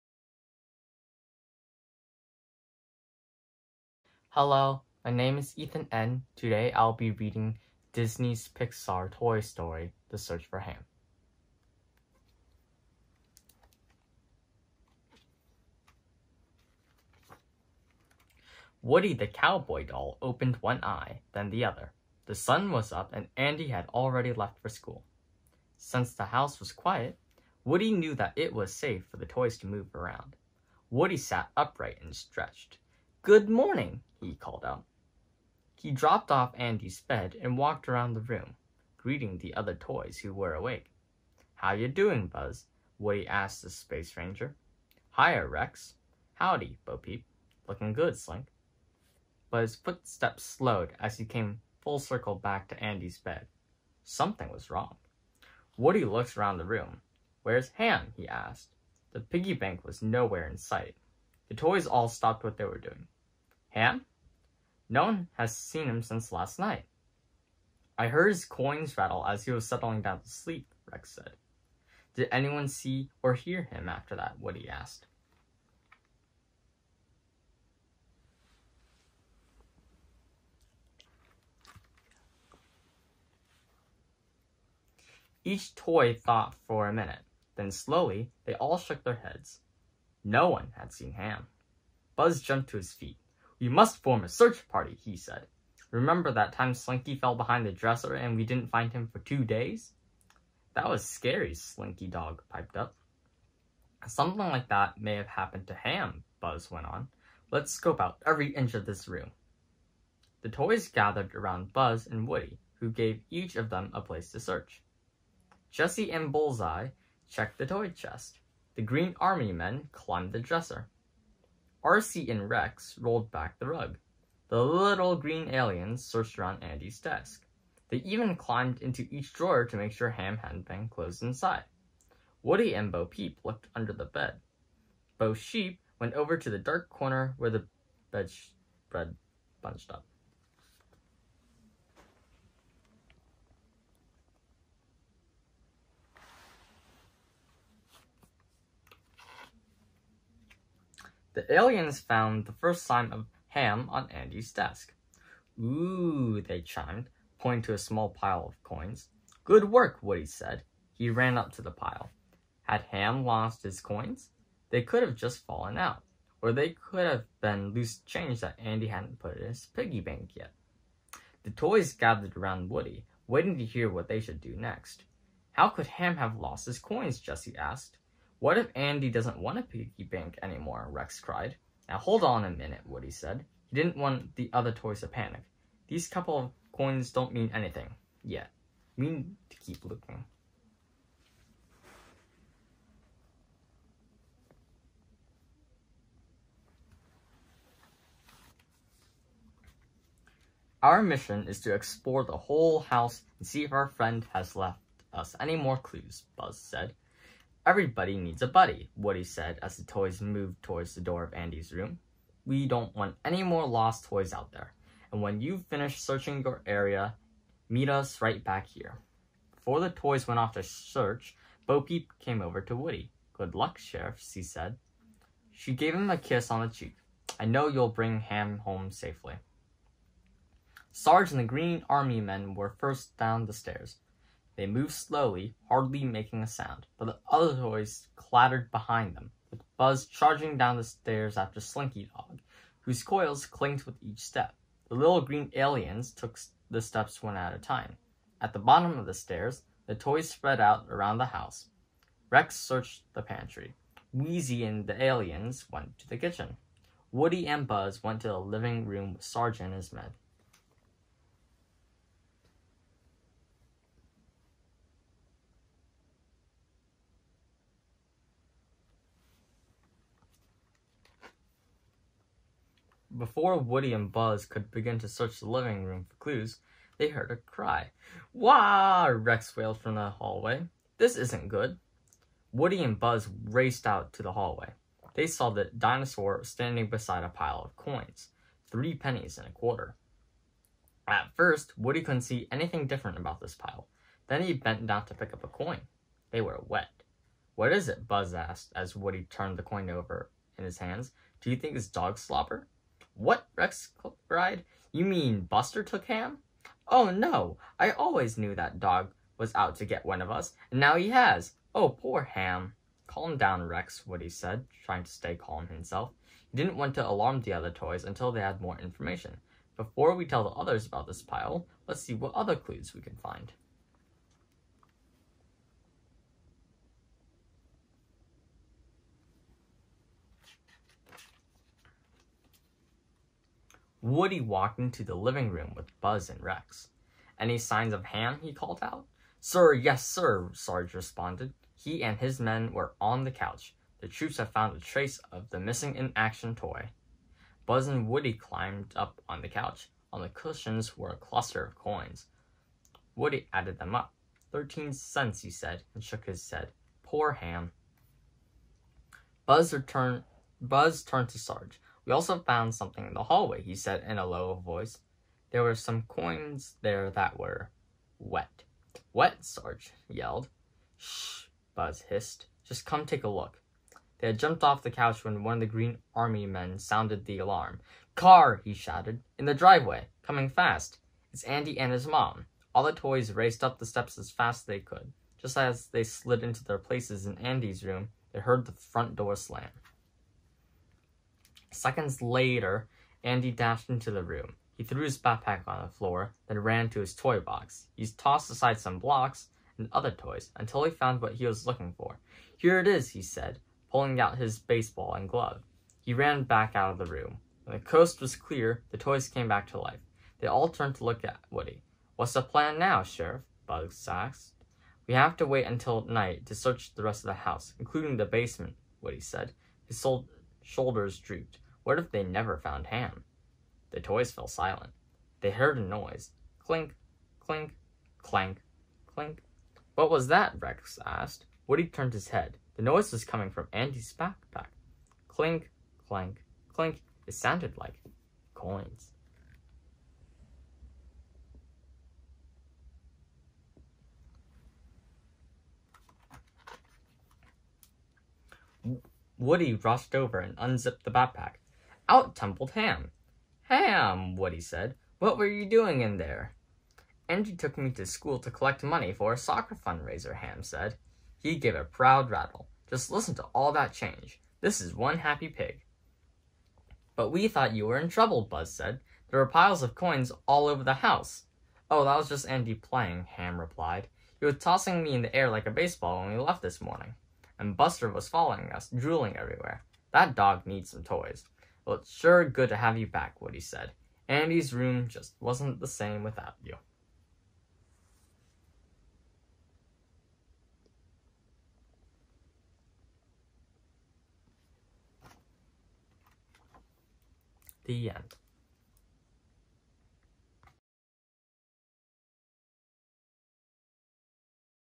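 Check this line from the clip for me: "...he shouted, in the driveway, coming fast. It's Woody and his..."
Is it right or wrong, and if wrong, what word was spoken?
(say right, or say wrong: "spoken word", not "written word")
wrong: "Andy", not "Woody".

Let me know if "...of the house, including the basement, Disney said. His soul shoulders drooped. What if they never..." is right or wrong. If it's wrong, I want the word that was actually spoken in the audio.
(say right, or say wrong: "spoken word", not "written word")
wrong: "Woody", not "Disney".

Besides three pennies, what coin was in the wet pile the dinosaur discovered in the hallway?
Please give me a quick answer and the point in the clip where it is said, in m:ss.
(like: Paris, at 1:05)
A quarter, at 4:49.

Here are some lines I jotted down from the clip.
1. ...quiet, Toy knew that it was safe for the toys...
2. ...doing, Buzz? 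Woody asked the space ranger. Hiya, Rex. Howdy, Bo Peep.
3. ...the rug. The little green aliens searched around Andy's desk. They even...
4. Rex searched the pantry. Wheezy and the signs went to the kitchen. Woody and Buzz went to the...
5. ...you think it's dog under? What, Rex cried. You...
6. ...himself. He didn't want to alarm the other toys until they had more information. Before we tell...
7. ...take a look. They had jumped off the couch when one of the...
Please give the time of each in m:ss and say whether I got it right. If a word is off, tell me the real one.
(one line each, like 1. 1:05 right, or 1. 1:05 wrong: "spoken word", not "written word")
1. 0:26 wrong: "Woody", not "Toy"
2. 0:41 right
3. 2:03 right
4. 4:12 wrong: "aliens", not "signs"
5. 5:01 wrong: "slobber", not "under"
6. 5:15 right
7. 6:13 right.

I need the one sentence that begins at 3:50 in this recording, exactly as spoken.
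Sarge and the Green Army men were first down the stairs.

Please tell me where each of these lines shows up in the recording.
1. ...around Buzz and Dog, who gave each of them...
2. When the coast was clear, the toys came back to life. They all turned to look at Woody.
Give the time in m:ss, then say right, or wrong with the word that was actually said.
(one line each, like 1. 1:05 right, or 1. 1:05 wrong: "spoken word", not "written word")
1. 1:51 wrong: "Woody", not "Dog"
2. 6:47 right.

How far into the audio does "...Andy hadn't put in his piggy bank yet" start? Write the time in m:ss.
2:48.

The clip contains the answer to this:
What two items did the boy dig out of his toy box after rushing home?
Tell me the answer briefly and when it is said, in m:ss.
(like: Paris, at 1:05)
Baseball and glove, at 6:44.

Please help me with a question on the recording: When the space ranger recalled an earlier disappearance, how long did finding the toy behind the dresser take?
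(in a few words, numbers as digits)
2.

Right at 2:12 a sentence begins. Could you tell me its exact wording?
Woody and Bo Peep looked under the bed.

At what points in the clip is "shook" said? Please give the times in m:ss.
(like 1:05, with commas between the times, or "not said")
1:28, 5:56.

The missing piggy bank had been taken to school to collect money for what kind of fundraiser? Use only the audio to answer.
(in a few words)
Soccer fundraiser.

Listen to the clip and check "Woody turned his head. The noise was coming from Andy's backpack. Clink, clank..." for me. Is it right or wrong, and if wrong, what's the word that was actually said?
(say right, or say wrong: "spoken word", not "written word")
right.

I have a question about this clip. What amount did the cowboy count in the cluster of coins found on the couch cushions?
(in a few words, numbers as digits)
13 cents.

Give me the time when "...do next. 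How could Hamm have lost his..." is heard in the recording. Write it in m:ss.
2:54.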